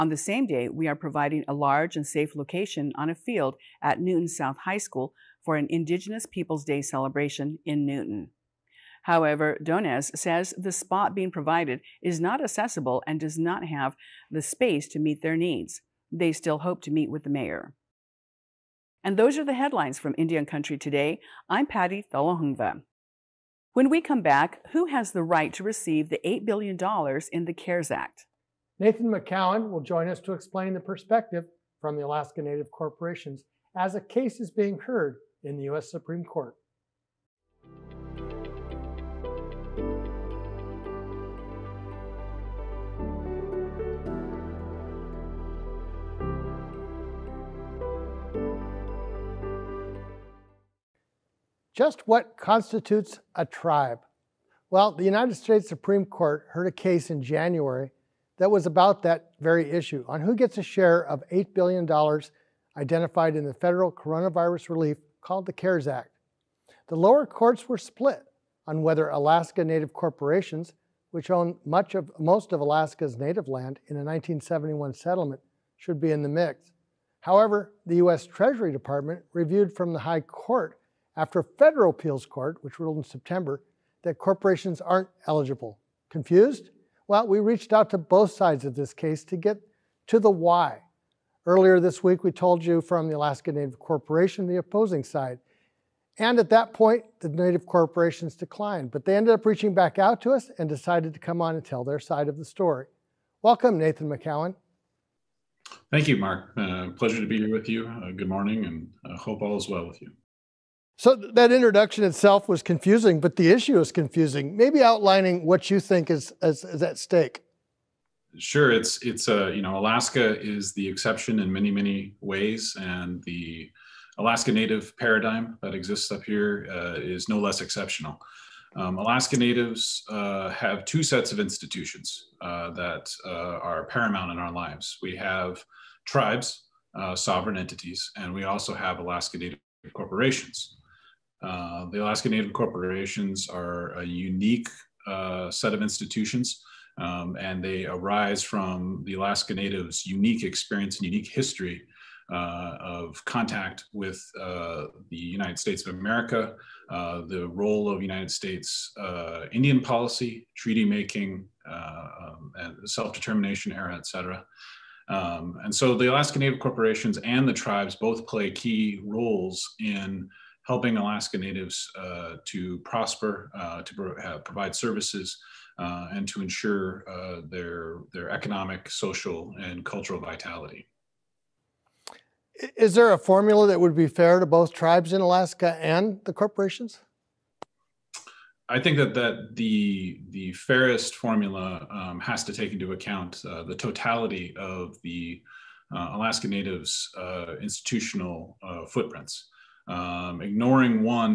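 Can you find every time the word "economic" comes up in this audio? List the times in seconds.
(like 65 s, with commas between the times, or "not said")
178 s.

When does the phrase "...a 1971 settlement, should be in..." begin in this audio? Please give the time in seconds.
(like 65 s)
73 s.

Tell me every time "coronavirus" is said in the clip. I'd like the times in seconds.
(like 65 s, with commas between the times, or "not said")
63 s.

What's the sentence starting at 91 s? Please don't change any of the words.
Earlier this week, we told you from the Alaska Native Corporation, the opposing side.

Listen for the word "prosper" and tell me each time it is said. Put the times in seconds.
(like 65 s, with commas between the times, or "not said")
172 s.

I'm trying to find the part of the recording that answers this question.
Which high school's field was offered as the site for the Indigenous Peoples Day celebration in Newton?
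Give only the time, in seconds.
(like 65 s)
3 s.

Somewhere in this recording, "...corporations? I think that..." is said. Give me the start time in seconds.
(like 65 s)
186 s.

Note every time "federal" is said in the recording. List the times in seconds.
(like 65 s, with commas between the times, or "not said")
63 s, 81 s.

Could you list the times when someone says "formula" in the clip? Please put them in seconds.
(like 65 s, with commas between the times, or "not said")
183 s, 191 s.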